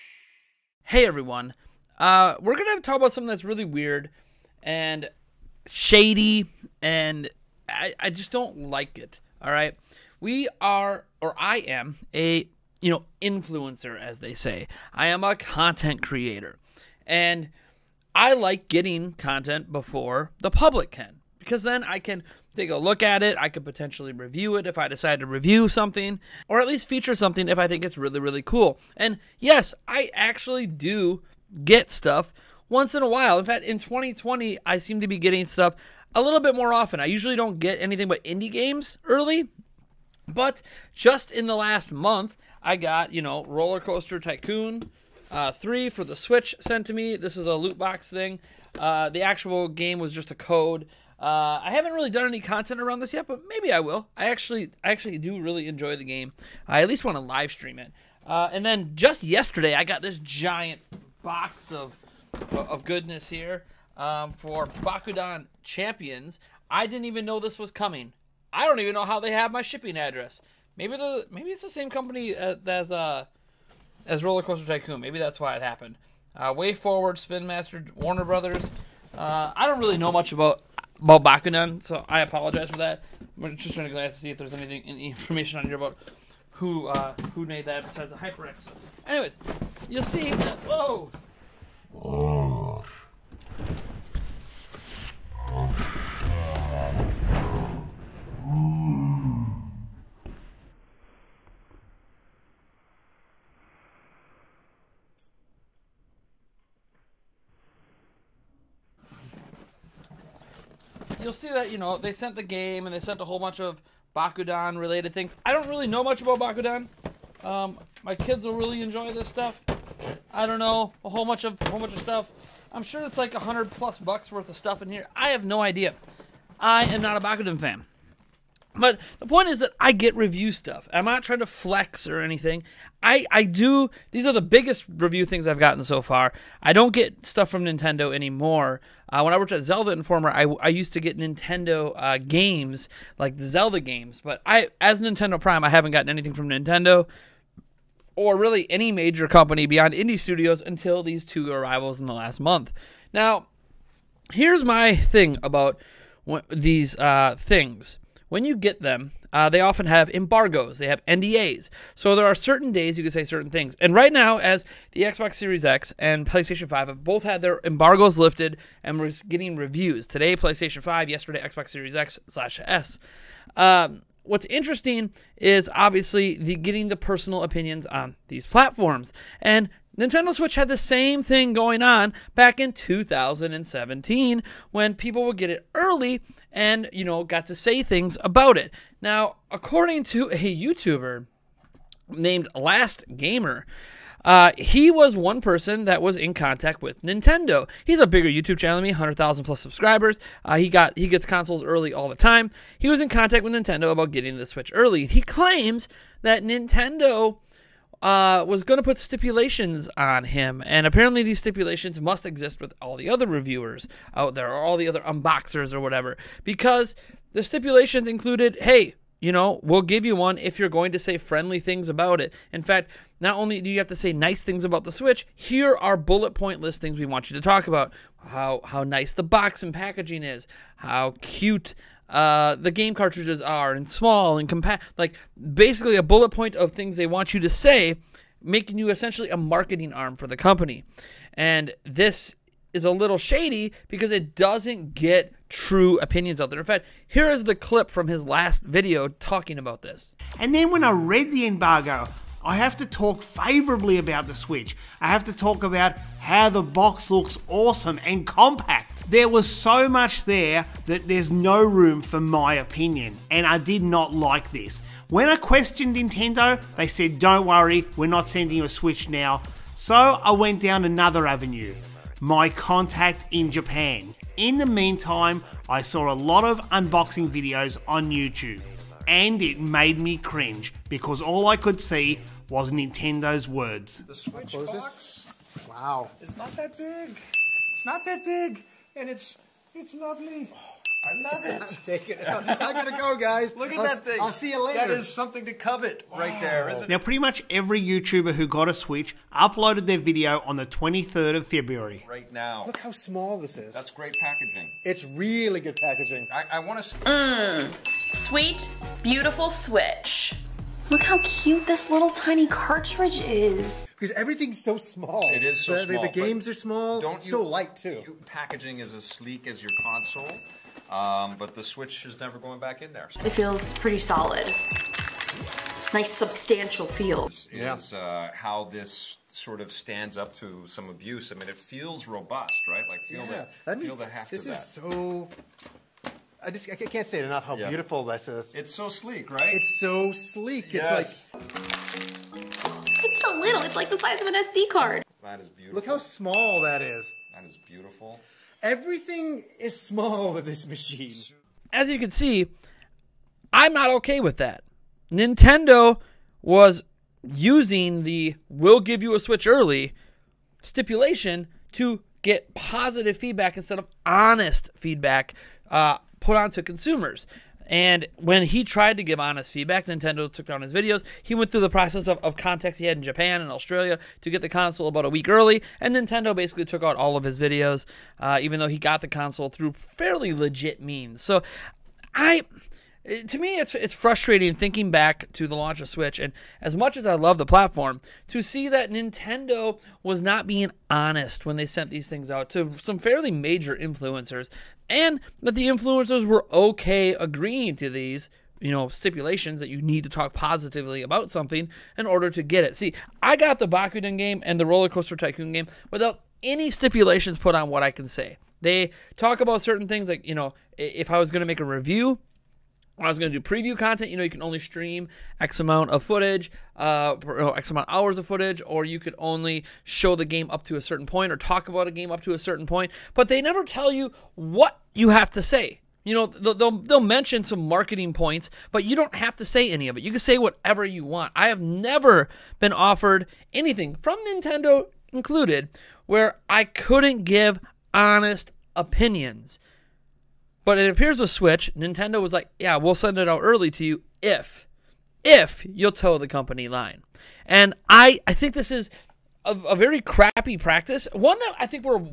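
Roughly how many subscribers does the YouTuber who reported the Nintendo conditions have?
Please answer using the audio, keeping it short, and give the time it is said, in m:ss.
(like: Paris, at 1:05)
100,000 plus, at 3:18.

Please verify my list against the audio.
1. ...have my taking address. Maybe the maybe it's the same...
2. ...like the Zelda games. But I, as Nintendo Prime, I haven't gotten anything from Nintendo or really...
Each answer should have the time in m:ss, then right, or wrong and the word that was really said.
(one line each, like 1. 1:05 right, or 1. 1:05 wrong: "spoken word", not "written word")
1. 1:09 wrong: "shipping", not "taking"
2. 2:23 right.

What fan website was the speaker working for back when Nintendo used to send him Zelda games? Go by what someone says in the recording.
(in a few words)
Zelda Informer.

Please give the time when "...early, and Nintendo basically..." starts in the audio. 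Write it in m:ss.
6:15.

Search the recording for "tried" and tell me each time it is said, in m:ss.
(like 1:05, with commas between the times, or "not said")
6:08.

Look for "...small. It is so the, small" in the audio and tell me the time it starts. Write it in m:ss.
5:14.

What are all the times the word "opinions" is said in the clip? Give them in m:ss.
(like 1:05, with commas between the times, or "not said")
2:57, 4:05, 4:22, 7:18.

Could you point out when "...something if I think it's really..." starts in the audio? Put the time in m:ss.
0:27.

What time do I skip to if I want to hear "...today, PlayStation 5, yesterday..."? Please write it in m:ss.
2:50.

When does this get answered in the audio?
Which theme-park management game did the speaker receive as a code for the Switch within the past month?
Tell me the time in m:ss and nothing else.
0:43.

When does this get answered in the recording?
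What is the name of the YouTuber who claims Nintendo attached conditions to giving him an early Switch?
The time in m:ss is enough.
3:12.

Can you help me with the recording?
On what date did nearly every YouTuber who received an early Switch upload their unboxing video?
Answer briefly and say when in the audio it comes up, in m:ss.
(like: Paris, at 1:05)
23rd of February, at 5:00.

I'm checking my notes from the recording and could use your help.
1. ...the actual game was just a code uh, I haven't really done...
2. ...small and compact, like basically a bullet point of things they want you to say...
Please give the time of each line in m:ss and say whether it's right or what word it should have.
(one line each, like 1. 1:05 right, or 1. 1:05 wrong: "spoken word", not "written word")
1. 0:49 right
2. 3:53 right.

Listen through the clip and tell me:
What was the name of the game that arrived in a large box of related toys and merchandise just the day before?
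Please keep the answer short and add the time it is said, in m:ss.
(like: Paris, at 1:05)
Bakugan Champions, at 1:04.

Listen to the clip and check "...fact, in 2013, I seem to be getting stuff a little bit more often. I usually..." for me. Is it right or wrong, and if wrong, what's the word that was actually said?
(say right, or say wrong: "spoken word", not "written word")
wrong: "2020", not "2013".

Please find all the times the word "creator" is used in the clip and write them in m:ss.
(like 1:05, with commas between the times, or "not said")
0:16.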